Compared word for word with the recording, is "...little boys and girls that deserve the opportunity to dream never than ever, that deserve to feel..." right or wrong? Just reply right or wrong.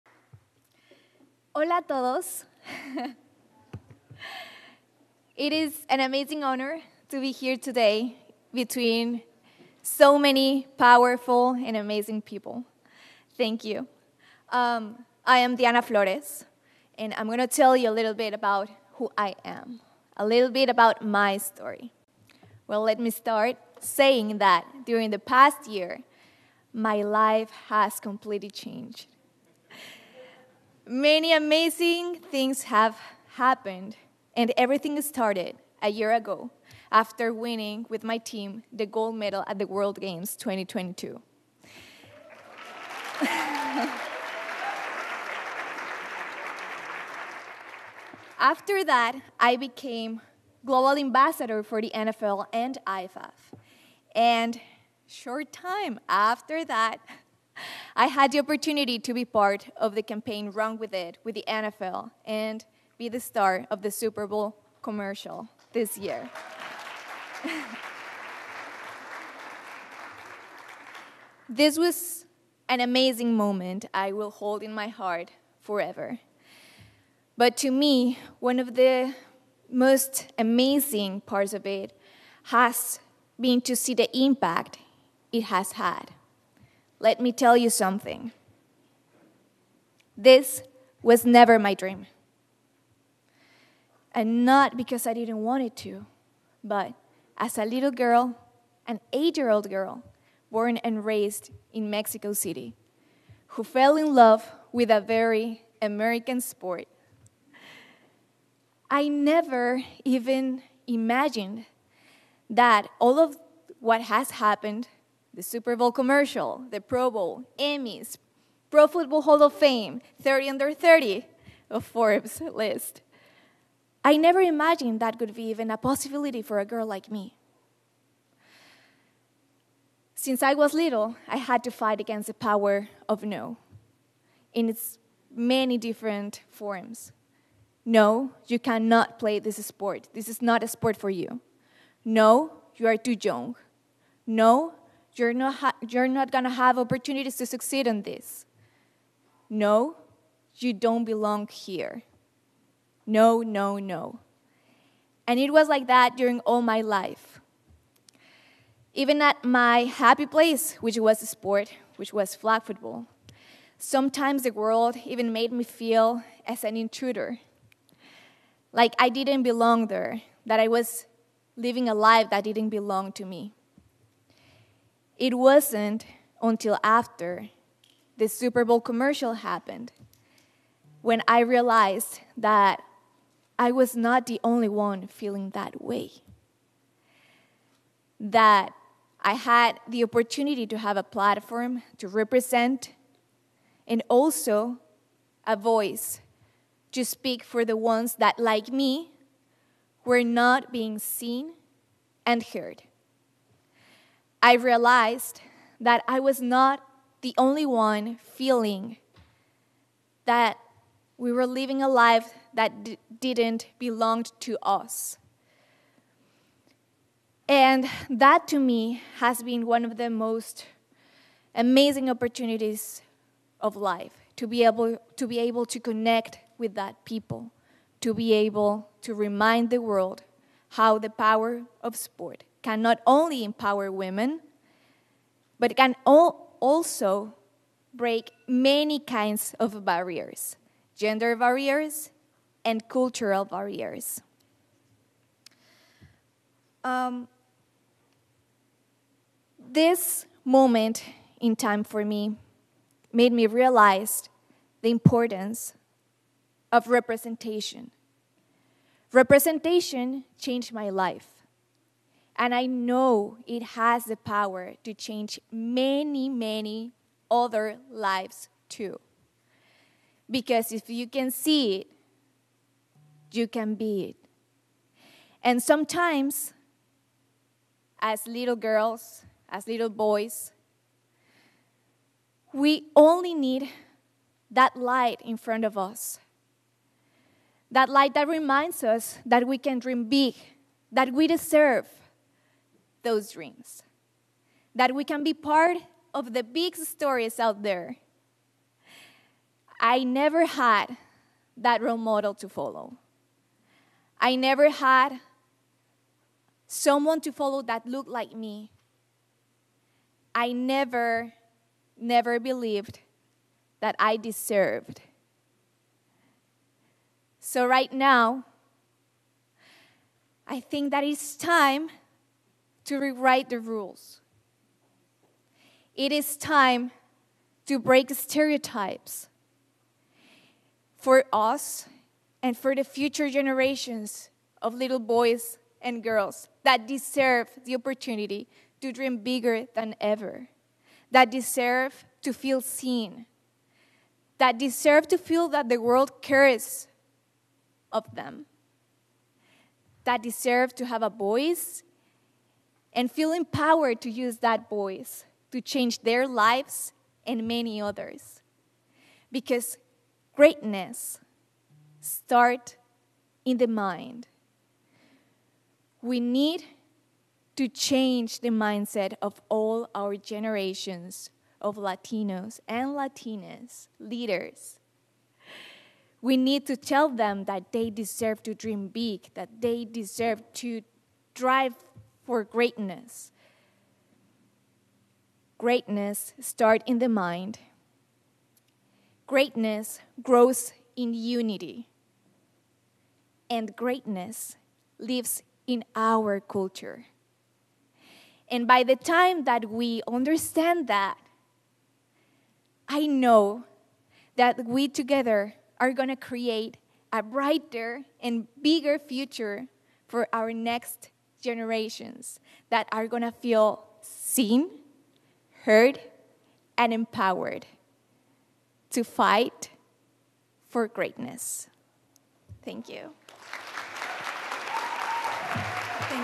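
wrong.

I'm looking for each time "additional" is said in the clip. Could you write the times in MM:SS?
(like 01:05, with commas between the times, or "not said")
not said.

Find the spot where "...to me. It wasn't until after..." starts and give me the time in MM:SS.
02:53.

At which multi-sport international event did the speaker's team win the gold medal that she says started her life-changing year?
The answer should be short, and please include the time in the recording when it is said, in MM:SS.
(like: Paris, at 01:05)
World Games 2022, at 00:39.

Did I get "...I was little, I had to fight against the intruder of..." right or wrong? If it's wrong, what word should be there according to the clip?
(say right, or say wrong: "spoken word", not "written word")
wrong: "power", not "intruder".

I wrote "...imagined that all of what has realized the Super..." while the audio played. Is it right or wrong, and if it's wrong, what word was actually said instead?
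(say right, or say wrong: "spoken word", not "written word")
wrong: "happened", not "realized".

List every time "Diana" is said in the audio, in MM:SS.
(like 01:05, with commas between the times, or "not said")
00:15.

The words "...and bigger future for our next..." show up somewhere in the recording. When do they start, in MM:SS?
06:48.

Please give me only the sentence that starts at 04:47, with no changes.
That light that reminds us that we can dream big, that we deserve, those dreams.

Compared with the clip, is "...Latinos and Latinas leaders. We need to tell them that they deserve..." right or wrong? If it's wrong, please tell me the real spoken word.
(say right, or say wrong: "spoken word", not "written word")
right.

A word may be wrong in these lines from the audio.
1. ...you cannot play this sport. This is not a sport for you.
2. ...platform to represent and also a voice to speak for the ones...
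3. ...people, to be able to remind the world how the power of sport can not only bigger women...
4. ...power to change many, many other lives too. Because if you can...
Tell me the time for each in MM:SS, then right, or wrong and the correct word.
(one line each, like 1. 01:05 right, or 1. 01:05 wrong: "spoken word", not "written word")
1. 02:18 right
2. 03:11 right
3. 03:47 wrong: "empower", not "bigger"
4. 04:24 right.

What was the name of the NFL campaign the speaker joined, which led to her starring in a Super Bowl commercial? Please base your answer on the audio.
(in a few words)
Run With It.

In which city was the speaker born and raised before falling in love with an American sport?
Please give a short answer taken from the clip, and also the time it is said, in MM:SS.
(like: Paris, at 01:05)
Mexico City, at 01:41.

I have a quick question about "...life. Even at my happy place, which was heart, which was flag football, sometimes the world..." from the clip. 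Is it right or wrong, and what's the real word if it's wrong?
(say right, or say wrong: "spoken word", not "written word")
wrong: "sport", not "heart".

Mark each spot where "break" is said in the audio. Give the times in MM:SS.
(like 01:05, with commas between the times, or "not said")
03:57, 05:27.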